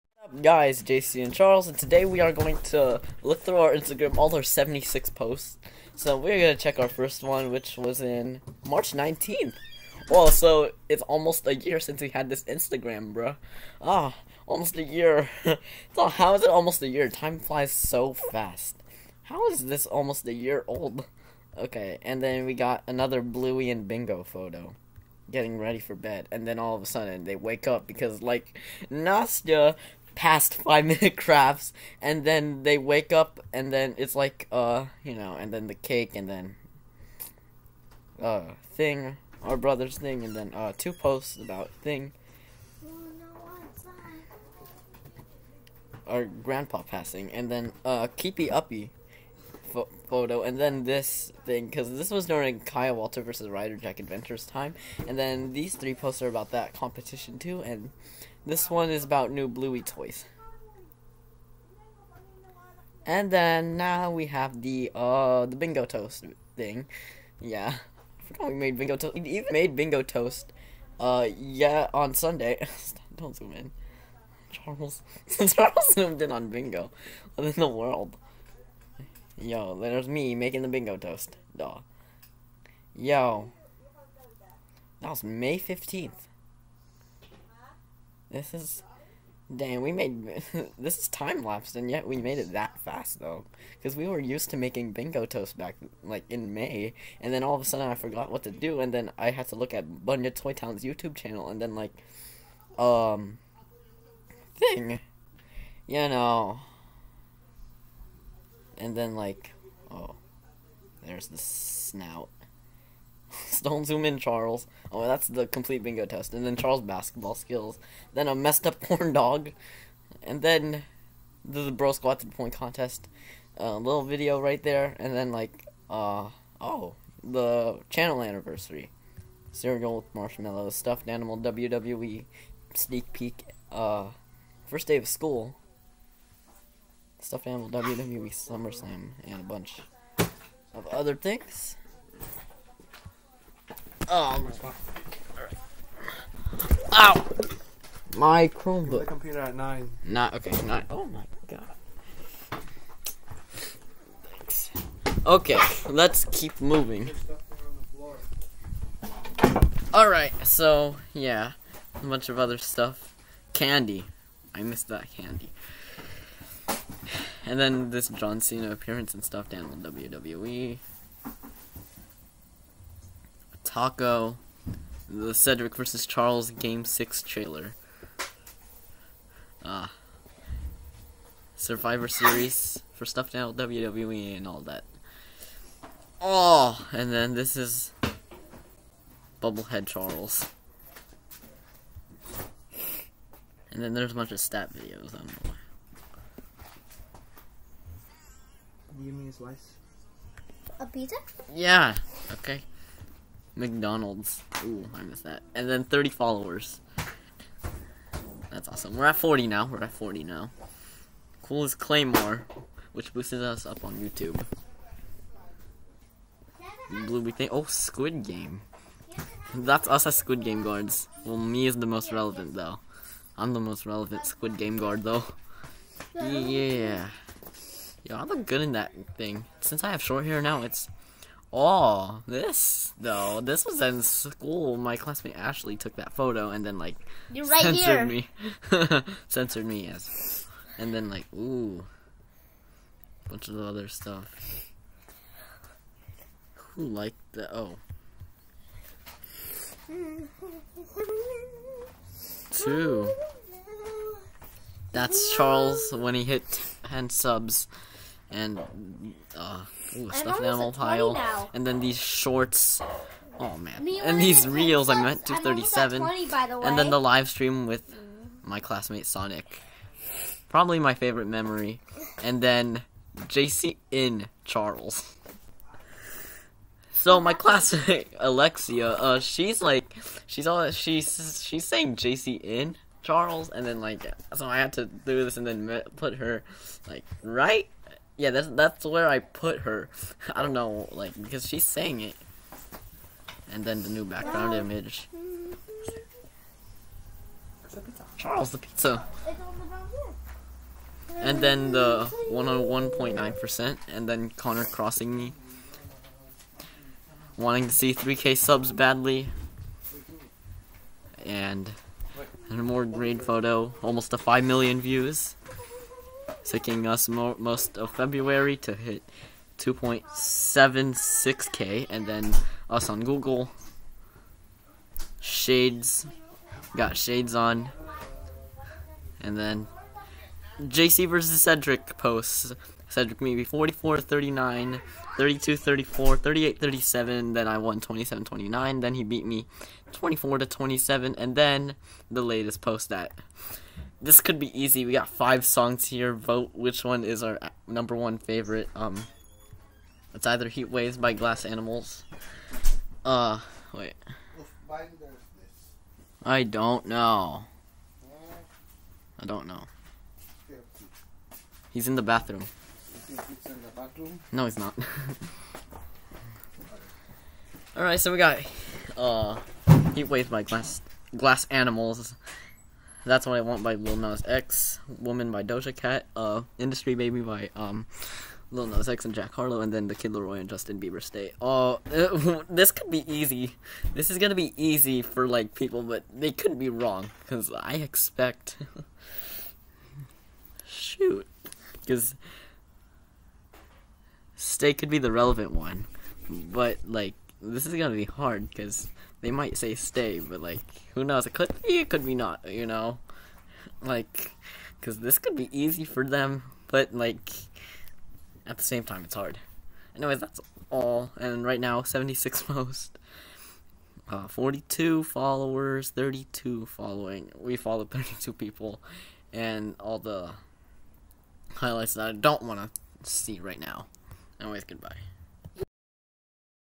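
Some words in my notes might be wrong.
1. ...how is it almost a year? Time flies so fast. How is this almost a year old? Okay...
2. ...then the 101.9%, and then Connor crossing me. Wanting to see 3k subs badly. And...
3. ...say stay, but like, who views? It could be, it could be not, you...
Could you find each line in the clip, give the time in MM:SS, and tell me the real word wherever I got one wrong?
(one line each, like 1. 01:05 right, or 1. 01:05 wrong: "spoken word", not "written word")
1. 00:16 right
2. 05:01 right
3. 06:39 wrong: "knows", not "views".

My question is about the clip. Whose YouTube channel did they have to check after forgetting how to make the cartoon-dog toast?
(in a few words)
Bunya Toy Town.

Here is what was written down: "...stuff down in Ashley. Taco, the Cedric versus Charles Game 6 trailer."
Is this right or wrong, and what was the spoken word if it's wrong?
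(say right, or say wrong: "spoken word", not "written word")
wrong: "WWE", not "Ashley".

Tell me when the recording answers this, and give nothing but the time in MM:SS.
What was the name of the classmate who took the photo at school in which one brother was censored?
03:55.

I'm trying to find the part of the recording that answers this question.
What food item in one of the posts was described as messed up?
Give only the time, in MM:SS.
01:58.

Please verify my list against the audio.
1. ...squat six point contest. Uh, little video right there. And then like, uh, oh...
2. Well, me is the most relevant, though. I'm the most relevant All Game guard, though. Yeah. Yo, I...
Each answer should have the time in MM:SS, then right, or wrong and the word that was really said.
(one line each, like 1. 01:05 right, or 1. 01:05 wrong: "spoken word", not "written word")
1. 02:01 wrong: "three", not "six"
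2. 03:41 wrong: "Squid", not "All".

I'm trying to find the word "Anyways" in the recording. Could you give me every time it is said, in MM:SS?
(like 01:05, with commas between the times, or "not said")
06:49, 07:04.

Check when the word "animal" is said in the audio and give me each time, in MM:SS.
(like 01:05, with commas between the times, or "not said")
02:11, 02:17, 04:20, 05:51, 06:11.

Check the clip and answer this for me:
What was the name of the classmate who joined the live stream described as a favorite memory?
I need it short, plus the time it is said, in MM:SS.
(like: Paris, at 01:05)
Sonic, at 04:29.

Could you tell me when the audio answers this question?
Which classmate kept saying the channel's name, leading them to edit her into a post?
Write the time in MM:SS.
04:38.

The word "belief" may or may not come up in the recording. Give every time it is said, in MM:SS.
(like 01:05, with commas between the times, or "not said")
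not said.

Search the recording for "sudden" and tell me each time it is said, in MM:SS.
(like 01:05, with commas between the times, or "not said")
00:26, 01:37.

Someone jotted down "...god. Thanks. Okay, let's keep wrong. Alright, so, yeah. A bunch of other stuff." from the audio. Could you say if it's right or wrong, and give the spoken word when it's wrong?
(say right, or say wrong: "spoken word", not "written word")
wrong: "moving", not "wrong".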